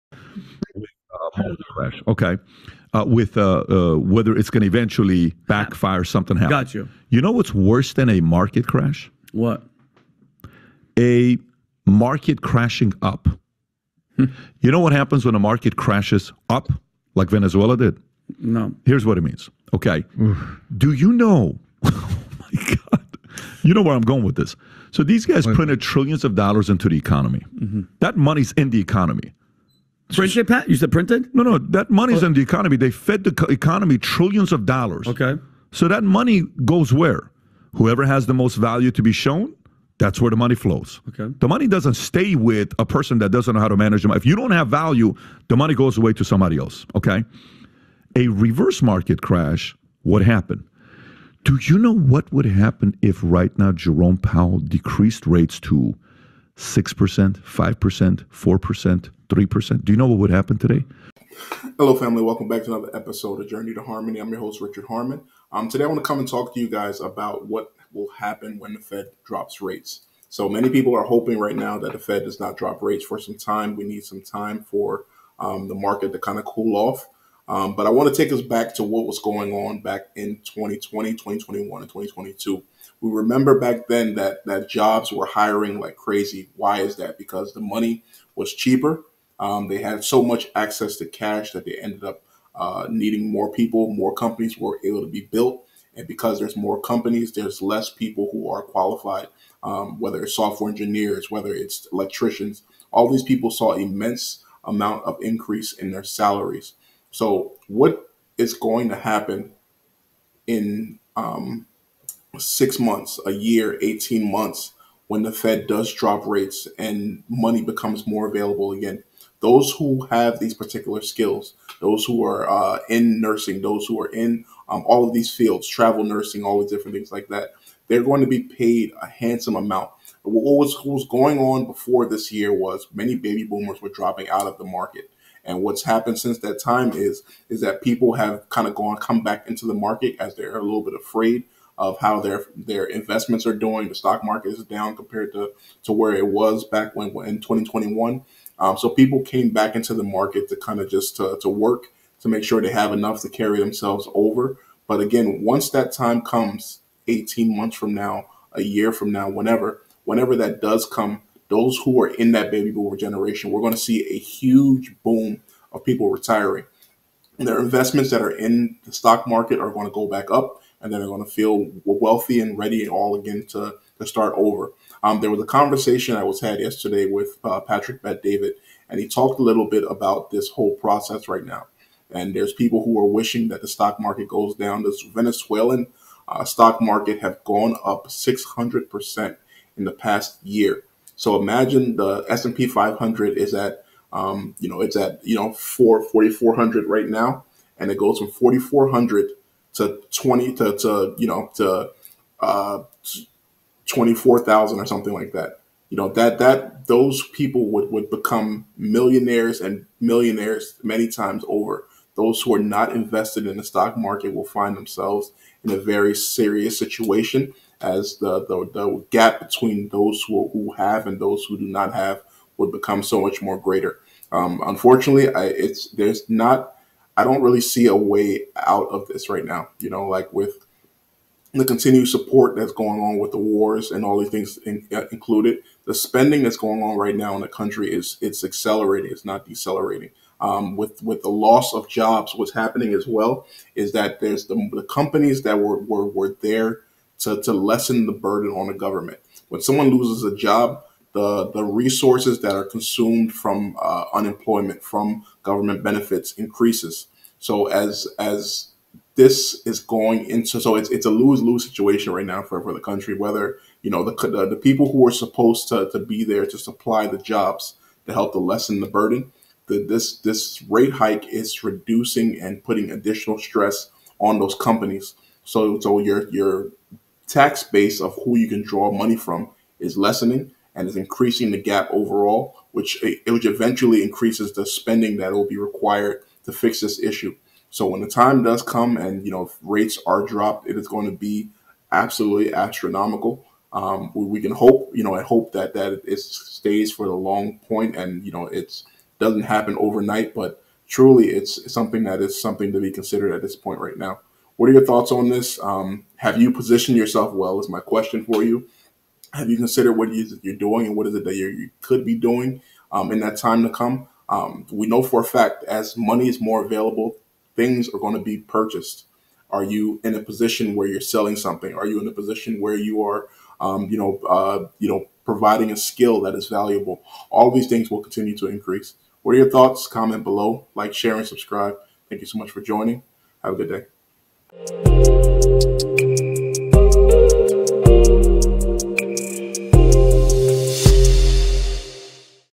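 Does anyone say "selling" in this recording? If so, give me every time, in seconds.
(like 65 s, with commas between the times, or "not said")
321 s.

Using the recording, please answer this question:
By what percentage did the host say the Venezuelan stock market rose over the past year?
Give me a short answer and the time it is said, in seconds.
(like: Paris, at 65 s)
600%, at 188 s.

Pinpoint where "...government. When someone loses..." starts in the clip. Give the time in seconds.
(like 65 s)
248 s.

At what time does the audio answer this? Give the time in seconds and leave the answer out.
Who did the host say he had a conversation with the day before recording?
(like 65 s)
177 s.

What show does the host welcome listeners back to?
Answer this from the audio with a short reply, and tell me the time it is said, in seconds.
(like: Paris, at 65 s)
Journey to Harmony, at 63 s.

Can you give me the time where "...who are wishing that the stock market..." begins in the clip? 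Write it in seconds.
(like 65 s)
182 s.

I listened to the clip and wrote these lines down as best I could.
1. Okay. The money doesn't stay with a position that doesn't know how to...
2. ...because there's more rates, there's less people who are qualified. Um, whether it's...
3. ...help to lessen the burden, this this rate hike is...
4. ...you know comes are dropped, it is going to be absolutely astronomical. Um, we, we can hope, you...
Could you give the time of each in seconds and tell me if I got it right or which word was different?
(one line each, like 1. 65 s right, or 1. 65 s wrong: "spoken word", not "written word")
1. 41 s wrong: "person", not "position"
2. 96 s wrong: "companies", not "rates"
3. 268 s right
4. 289 s wrong: "rates", not "comes".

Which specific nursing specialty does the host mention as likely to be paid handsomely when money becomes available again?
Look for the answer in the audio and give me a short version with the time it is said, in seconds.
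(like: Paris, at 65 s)
Travel nursing, at 125 s.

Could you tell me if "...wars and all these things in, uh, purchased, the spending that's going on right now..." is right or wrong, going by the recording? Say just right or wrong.
wrong.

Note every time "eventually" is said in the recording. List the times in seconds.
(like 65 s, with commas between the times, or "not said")
4 s, 283 s.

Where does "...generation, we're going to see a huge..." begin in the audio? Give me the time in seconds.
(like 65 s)
162 s.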